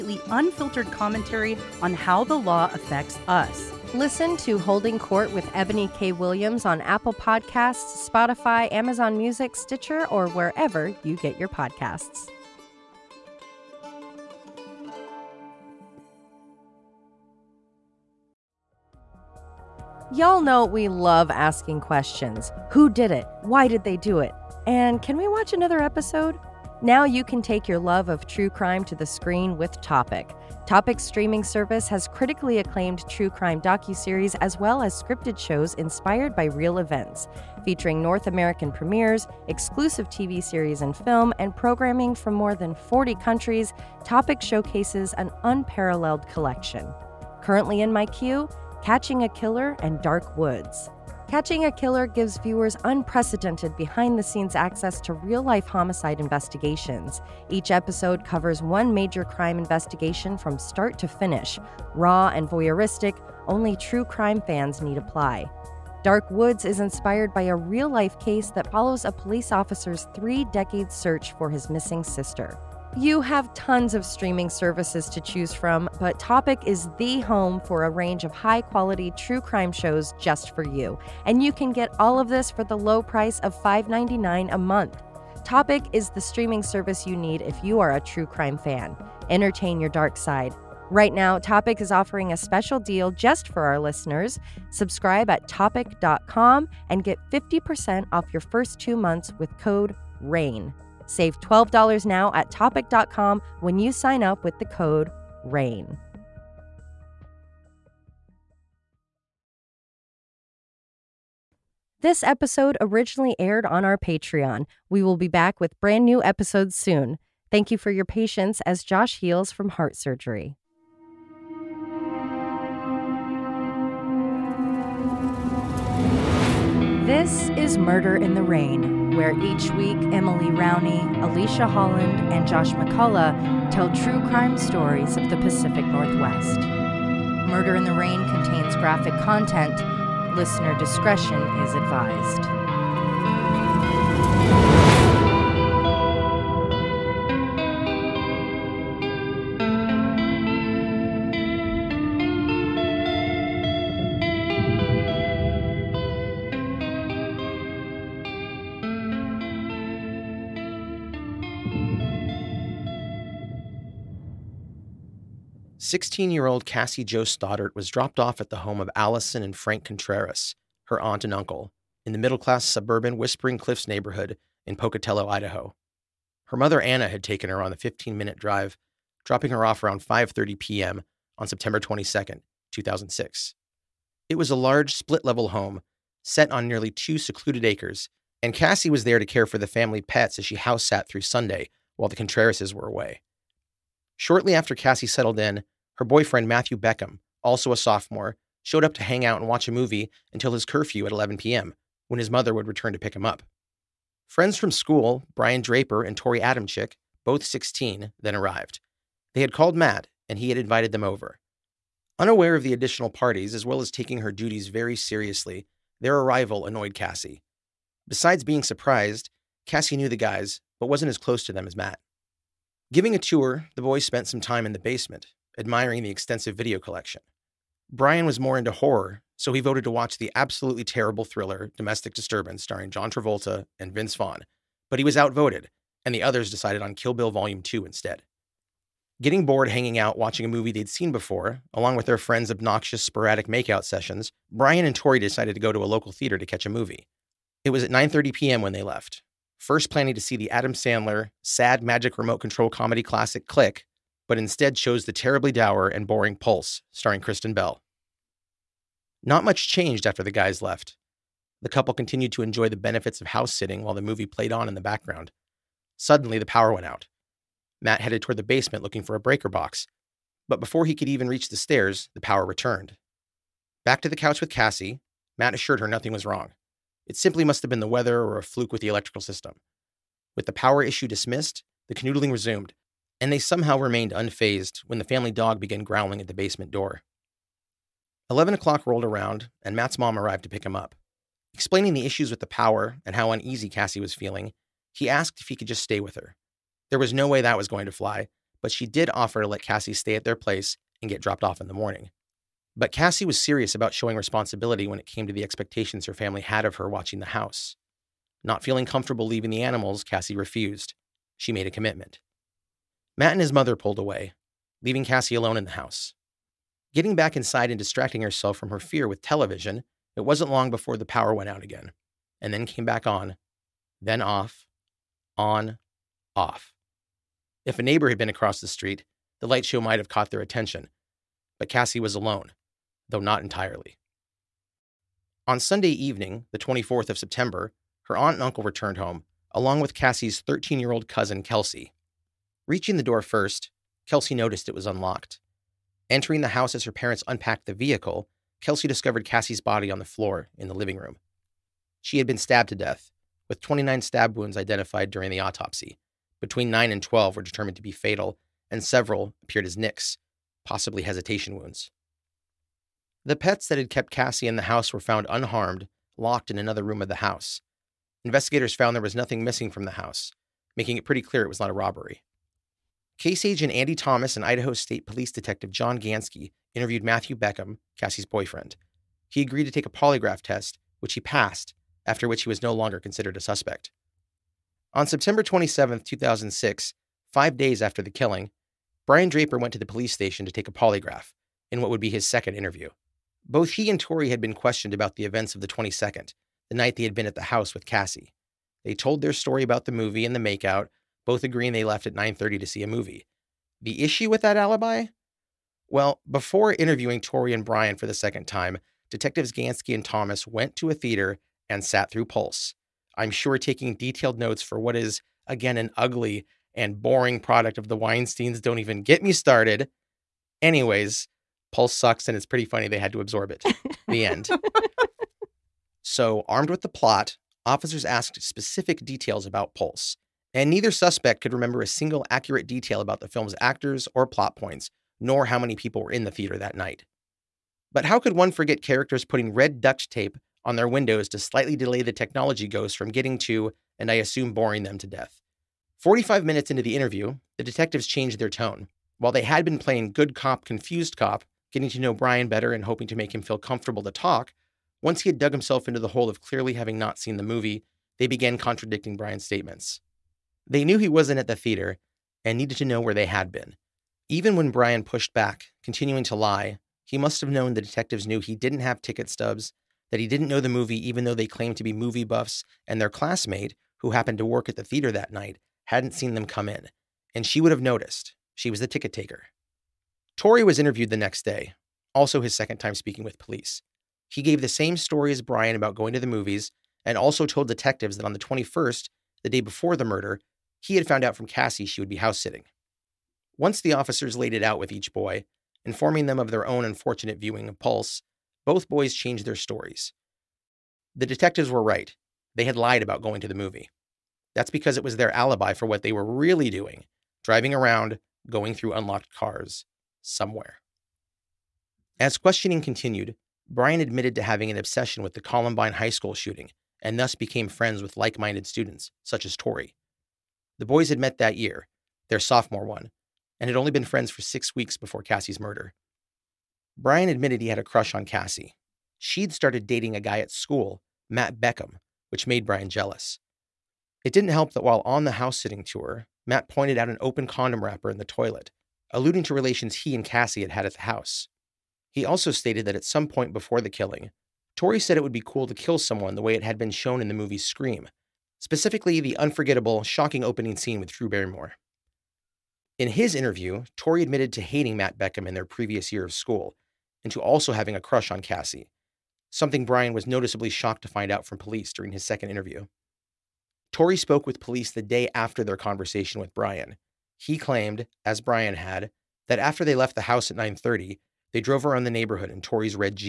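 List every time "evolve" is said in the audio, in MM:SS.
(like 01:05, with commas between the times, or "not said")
not said.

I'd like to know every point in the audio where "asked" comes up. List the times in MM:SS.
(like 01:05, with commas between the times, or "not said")
04:55, 07:08.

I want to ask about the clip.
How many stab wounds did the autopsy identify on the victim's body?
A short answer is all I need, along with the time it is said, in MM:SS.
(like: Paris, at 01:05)
29, at 05:53.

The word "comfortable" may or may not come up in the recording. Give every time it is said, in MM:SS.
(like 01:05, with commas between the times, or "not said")
05:08, 07:33.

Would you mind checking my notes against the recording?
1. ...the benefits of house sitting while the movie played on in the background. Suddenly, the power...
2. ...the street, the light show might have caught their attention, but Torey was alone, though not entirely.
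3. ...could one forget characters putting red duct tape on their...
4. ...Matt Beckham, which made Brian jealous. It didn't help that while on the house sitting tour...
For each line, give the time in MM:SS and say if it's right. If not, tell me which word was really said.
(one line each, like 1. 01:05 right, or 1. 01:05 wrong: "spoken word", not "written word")
1. 04:22 right
2. 05:28 wrong: "Cassie", not "Torey"
3. 07:18 right
4. 08:51 right.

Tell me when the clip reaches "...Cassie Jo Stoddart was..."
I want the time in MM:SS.
02:46.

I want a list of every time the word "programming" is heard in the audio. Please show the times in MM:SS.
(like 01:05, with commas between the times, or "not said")
00:41.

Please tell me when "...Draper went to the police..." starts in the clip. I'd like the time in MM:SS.
06:29.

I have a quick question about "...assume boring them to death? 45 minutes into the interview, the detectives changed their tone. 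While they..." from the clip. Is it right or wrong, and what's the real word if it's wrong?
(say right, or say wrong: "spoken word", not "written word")
right.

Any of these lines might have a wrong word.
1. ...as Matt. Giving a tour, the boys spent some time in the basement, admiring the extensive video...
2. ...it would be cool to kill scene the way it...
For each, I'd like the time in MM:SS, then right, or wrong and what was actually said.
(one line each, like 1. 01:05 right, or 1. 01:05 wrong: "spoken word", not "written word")
1. 03:41 right
2. 09:05 wrong: "someone", not "scene".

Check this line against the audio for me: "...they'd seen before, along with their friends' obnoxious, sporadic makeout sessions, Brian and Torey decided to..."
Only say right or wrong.
right.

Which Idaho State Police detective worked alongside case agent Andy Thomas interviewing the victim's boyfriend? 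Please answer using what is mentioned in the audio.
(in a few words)
John Gansky.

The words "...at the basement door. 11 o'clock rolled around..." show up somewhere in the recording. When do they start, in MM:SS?
04:46.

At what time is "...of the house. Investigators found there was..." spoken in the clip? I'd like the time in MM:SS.
06:07.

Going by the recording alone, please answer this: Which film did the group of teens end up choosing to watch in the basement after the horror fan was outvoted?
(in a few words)
Kill Bill Volume 2.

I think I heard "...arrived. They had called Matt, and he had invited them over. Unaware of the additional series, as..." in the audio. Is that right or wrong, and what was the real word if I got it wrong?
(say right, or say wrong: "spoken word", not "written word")
wrong: "parties", not "series".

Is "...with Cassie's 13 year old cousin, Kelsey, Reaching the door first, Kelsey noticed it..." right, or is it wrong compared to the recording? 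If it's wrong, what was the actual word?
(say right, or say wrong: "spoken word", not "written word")
right.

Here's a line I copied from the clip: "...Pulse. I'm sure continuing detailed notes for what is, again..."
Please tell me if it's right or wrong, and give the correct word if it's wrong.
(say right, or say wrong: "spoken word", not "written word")
wrong: "taking", not "continuing".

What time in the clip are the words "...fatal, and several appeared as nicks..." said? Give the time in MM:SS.
05:57.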